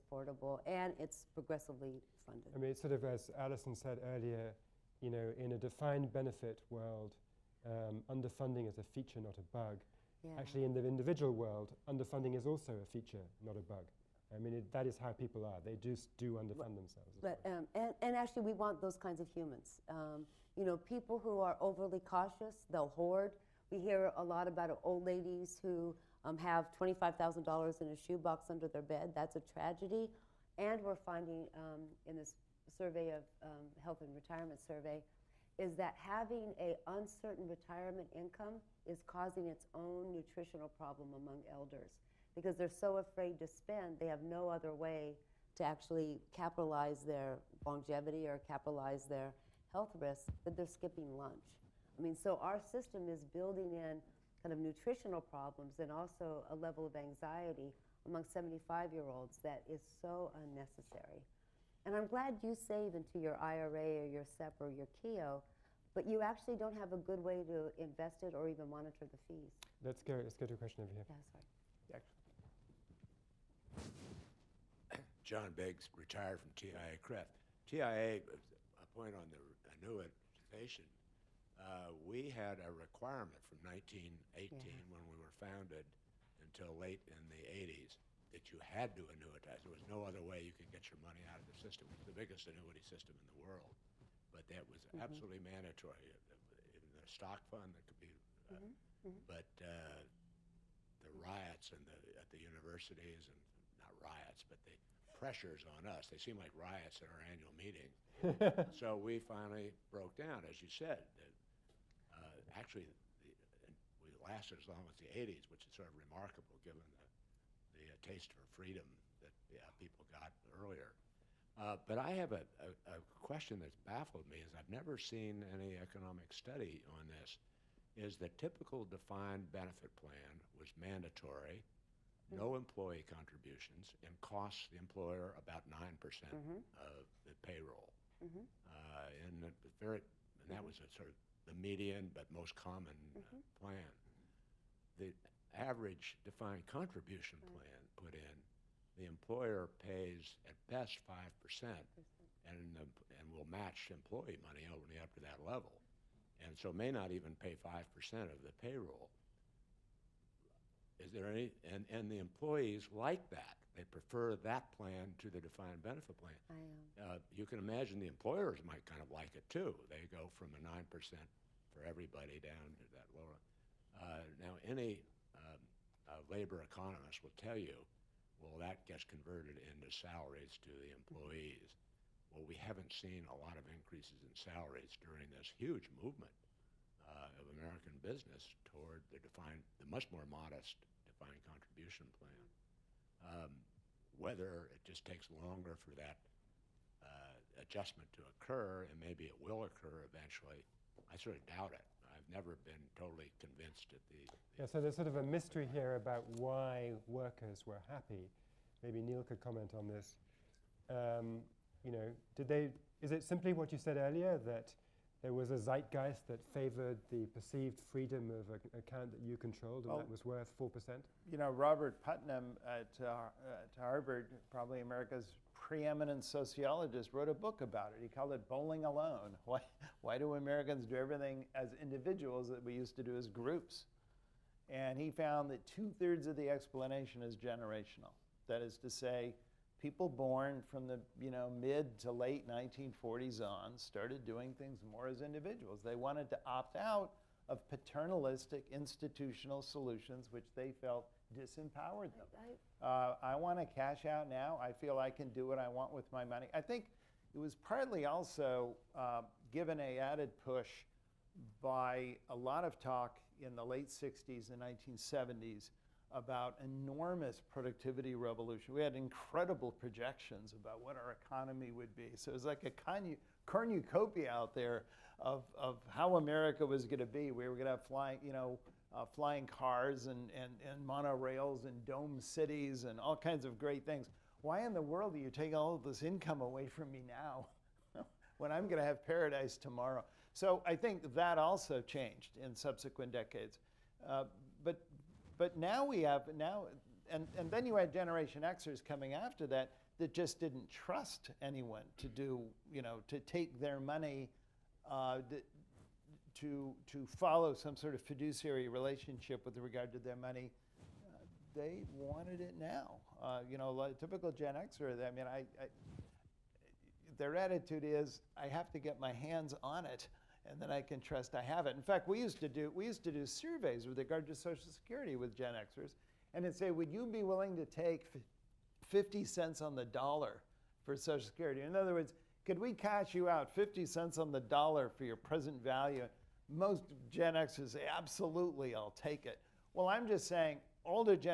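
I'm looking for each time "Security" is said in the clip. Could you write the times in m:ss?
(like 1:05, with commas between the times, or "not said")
5:24, 5:31.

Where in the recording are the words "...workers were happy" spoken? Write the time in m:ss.
3:27.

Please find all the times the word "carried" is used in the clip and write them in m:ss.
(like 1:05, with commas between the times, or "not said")
not said.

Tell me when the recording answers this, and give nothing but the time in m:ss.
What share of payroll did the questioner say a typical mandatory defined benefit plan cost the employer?
2:15.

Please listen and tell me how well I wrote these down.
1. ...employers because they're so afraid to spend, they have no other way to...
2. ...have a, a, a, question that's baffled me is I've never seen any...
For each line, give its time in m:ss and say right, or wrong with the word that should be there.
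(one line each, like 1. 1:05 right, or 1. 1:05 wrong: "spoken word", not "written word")
1. 0:41 wrong: "elders", not "employers"
2. 2:02 right.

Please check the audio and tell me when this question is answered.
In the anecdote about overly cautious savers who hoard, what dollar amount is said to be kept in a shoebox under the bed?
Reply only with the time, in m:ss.
0:26.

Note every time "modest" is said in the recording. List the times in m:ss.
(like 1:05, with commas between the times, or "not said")
3:10.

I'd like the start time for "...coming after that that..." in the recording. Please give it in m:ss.
4:58.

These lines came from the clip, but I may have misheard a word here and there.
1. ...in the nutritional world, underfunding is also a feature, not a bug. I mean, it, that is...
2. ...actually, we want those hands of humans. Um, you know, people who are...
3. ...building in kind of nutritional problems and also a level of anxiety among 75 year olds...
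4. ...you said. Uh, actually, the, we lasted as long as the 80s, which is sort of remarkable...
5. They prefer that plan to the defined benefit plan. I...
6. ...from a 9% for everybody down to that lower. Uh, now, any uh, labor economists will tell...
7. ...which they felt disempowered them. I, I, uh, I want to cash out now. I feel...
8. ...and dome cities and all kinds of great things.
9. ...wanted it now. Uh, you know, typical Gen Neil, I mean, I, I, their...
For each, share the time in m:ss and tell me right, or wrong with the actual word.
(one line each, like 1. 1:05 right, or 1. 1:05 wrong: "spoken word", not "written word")
1. 0:10 wrong: "individual", not "nutritional"
2. 0:18 wrong: "kinds", not "hands"
3. 0:53 right
4. 1:50 right
5. 2:43 right
6. 2:50 right
7. 4:10 right
8. 4:41 right
9. 5:11 wrong: "Xer", not "Neil".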